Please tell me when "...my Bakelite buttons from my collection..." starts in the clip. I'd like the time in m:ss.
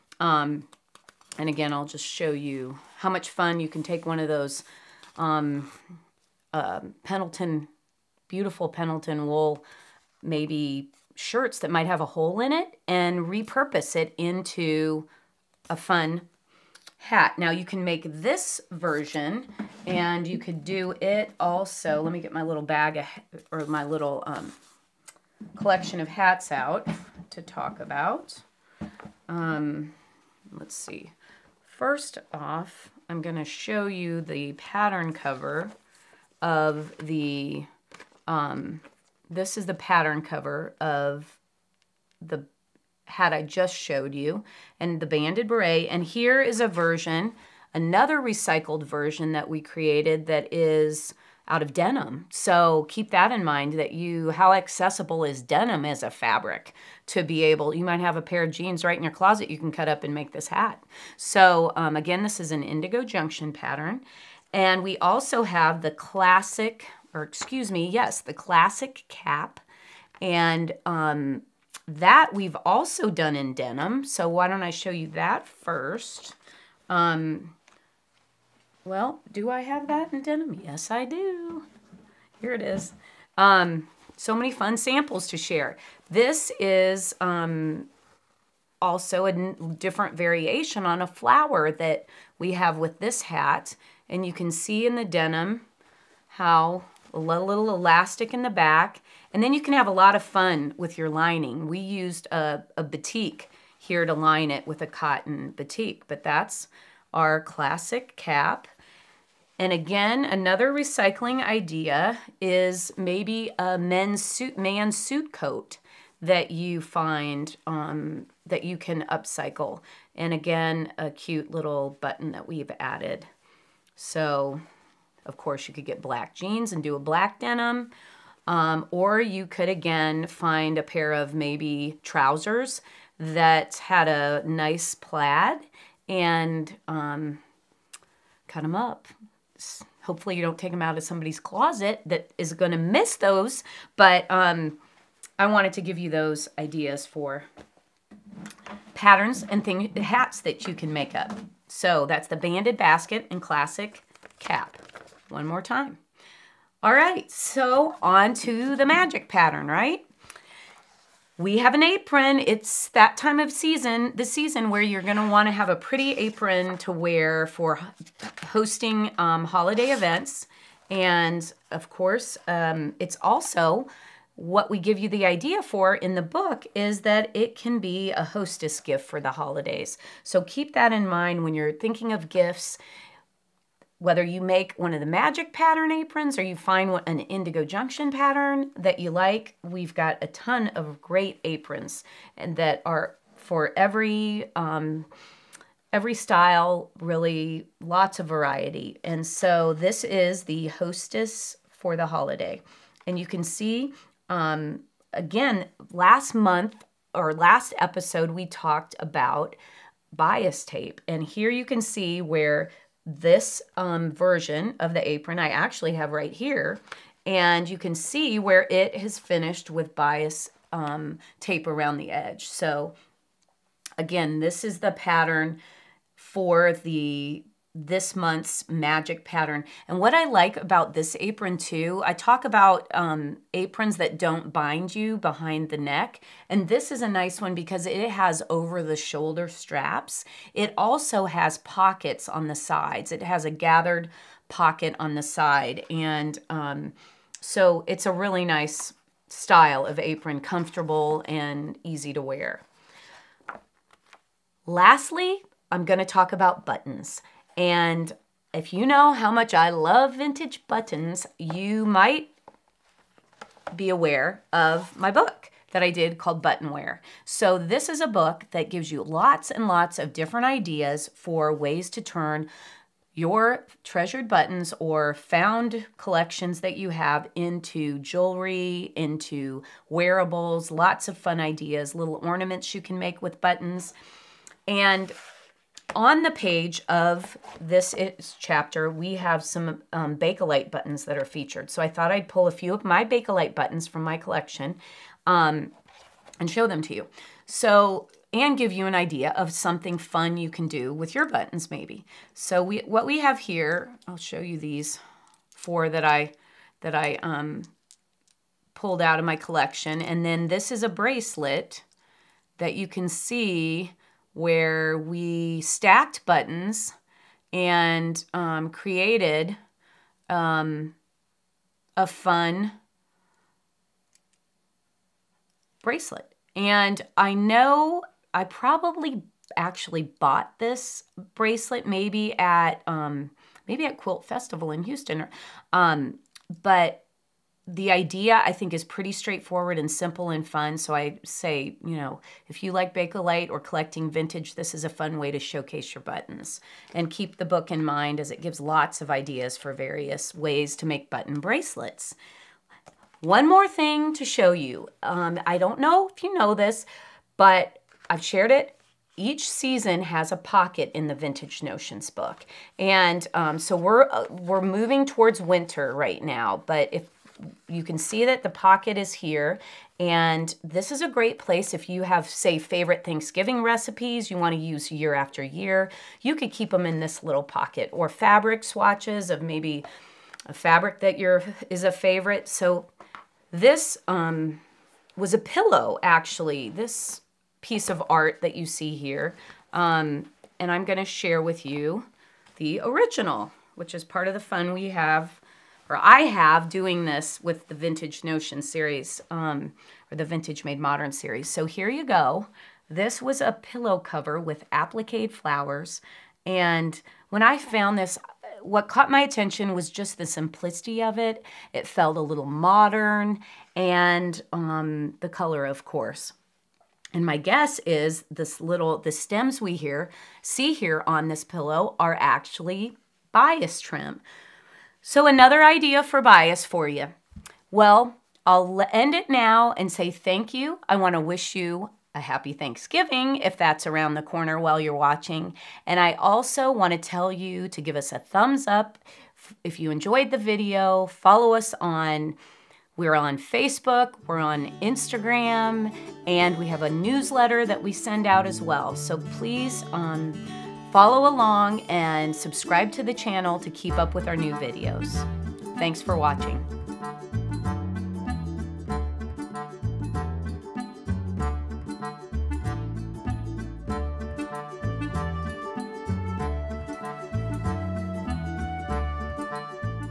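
4:52.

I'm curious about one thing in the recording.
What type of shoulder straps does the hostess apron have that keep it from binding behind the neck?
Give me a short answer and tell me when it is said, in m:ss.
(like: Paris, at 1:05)
over the shoulder straps, at 3:58.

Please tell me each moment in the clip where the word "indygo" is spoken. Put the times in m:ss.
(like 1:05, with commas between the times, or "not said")
1:02, 3:07.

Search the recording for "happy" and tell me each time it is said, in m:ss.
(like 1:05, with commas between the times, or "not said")
7:12.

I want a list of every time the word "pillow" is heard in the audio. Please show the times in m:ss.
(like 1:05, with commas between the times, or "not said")
6:25, 6:43, 7:01.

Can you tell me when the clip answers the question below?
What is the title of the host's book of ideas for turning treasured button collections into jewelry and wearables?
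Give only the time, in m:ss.
4:26.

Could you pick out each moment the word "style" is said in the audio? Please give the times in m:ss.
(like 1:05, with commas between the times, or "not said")
3:16, 4:09.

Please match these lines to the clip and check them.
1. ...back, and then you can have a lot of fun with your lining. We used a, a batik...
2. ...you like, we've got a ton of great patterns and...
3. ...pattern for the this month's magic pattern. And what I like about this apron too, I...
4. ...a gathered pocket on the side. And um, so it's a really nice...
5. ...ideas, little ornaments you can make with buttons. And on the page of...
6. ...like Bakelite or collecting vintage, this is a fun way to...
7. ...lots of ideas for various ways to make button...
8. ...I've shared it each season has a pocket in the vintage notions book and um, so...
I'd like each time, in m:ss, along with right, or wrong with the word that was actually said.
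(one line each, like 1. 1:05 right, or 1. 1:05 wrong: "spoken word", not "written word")
1. 1:38 right
2. 3:08 wrong: "aprons", not "patterns"
3. 3:44 right
4. 4:03 right
5. 4:41 right
6. 5:42 right
7. 5:48 right
8. 5:58 right.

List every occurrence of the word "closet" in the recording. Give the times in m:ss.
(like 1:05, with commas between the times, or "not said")
0:59, 2:21.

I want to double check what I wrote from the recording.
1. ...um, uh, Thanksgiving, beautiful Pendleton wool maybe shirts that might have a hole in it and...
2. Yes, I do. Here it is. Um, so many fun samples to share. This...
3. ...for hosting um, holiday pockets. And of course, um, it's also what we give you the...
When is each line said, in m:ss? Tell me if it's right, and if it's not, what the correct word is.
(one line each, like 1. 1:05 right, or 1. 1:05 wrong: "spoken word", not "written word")
1. 0:05 wrong: "Pendleton", not "Thanksgiving"
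2. 1:20 right
3. 2:47 wrong: "events", not "pockets".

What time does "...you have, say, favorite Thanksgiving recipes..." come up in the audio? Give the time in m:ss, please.
6:11.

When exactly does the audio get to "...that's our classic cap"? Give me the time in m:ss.
1:46.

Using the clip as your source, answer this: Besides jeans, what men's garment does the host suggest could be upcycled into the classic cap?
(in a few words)
suit coat.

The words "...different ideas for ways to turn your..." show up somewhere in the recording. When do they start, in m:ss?
4:30.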